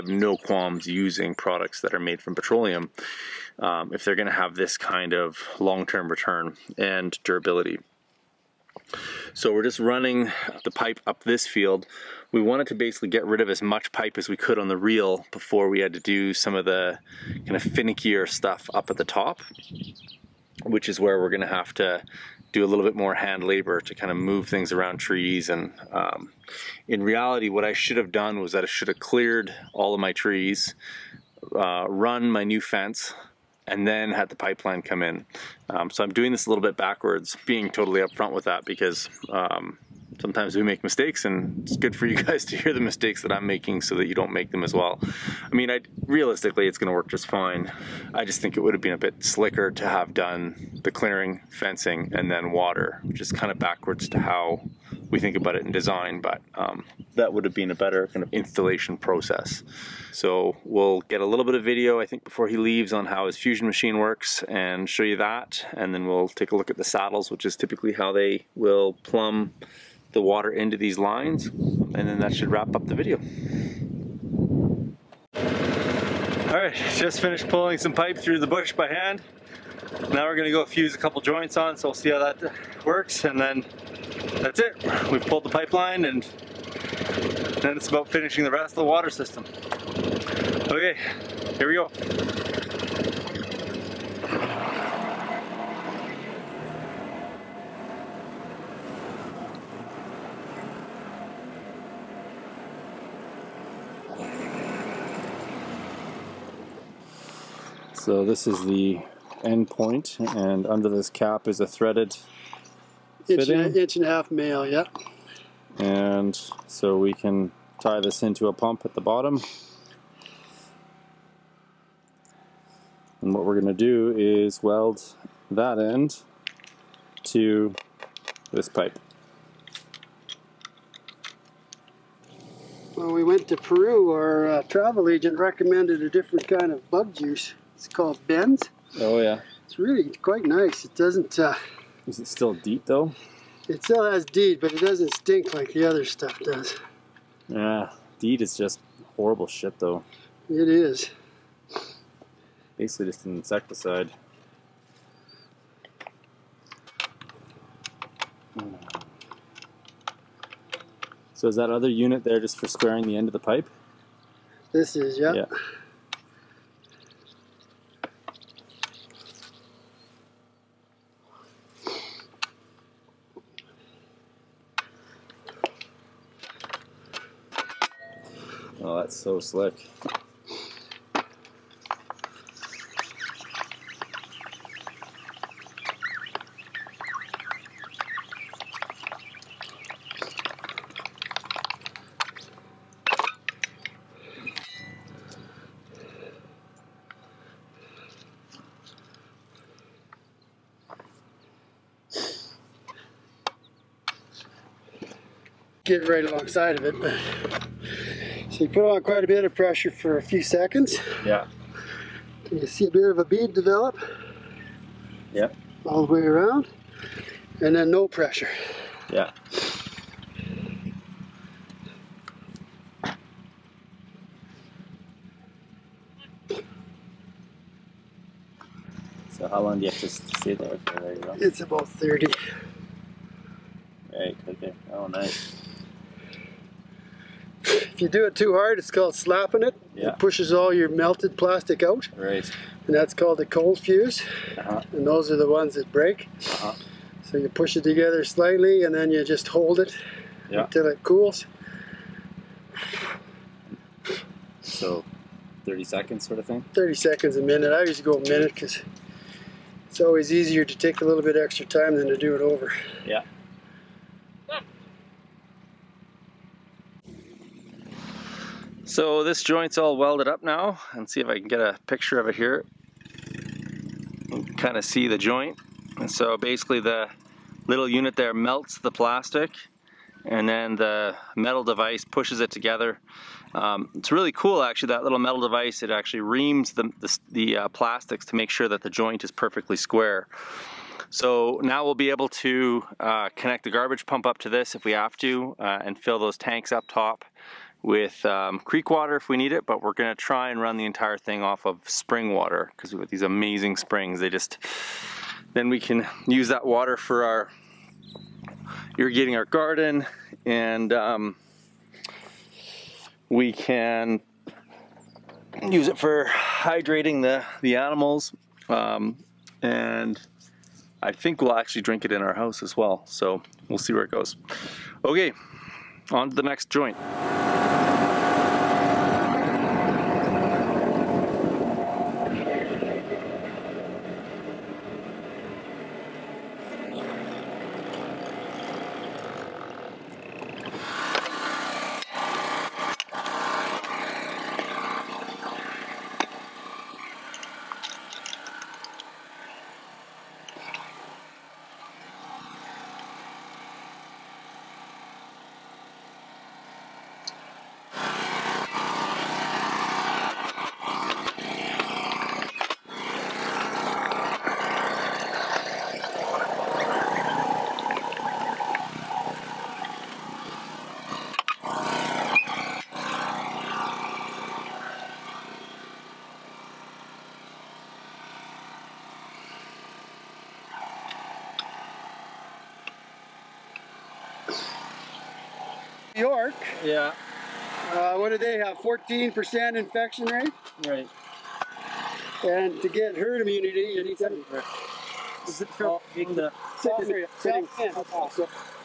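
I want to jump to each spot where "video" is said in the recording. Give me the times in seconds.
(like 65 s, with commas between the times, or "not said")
61 s, 72 s.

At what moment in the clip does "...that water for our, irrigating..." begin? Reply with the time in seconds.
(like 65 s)
306 s.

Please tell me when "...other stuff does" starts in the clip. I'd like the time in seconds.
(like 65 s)
145 s.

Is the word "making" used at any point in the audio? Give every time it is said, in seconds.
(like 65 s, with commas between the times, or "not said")
43 s.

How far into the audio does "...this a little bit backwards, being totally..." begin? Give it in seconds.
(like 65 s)
36 s.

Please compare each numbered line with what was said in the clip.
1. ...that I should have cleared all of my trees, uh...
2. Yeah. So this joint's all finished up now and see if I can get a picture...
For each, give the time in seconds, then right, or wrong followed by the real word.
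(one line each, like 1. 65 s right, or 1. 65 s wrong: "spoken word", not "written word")
1. 28 s right
2. 263 s wrong: "welded", not "finished".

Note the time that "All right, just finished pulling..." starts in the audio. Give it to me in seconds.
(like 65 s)
76 s.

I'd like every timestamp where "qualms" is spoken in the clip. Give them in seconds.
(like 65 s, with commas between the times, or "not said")
0 s.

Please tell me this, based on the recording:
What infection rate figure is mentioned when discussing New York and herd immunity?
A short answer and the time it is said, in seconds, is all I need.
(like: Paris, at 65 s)
14%, at 388 s.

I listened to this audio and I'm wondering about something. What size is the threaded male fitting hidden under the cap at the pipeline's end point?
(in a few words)
inch and a half.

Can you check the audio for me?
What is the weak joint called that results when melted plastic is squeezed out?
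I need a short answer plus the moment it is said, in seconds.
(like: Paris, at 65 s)
cold fuse, at 243 s.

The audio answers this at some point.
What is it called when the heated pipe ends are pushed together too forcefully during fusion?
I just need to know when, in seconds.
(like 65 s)
239 s.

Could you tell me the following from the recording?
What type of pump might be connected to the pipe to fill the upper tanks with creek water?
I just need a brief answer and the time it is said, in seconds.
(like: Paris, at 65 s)
garbage pump, at 293 s.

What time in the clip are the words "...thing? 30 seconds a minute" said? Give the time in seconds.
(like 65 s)
256 s.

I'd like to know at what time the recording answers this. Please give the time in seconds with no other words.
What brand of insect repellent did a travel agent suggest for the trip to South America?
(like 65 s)
138 s.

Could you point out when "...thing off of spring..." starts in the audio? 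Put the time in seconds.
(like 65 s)
301 s.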